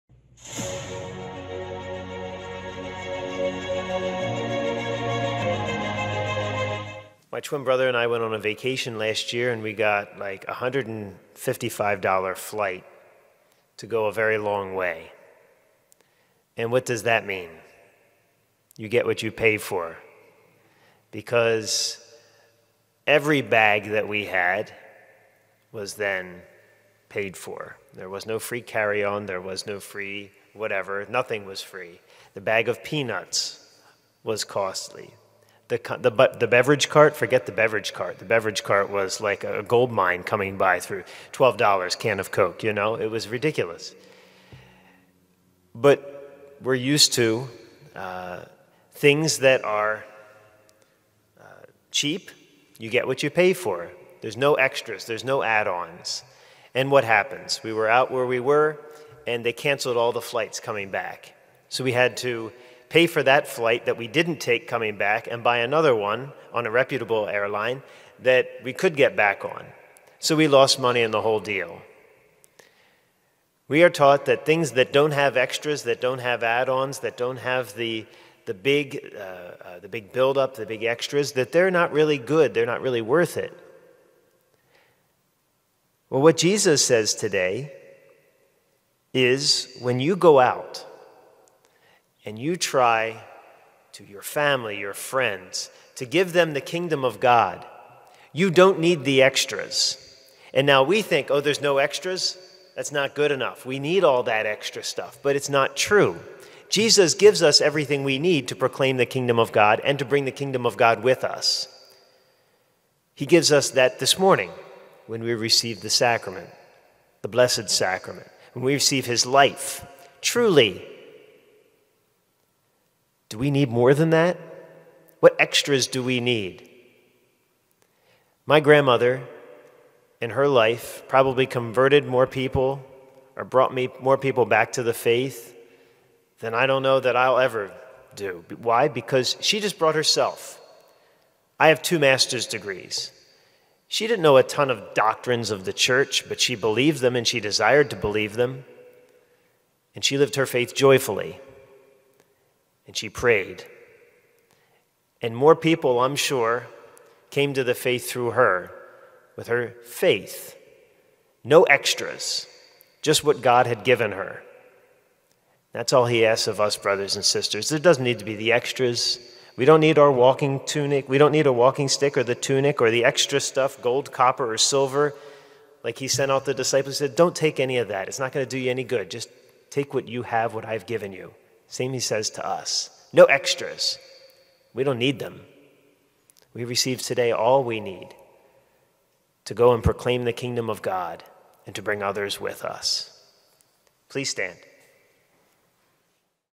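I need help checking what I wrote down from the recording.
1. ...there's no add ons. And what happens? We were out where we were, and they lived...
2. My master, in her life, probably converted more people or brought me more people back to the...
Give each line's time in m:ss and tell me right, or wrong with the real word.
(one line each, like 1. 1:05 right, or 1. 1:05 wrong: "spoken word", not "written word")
1. 0:55 wrong: "canceled", not "lived"
2. 2:08 wrong: "grandmother", not "master".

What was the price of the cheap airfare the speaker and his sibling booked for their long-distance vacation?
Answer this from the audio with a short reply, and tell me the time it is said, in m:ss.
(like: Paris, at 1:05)
$155, at 0:10.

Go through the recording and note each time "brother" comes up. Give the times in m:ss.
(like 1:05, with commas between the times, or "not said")
0:07, 2:46.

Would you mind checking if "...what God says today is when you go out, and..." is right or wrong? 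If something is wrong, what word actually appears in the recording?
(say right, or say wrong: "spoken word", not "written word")
wrong: "Jesus", not "God".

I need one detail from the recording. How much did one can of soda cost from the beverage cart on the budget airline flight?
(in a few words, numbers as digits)
$12.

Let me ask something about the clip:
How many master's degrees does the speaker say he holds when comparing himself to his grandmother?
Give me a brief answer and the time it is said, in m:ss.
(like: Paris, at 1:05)
2, at 2:21.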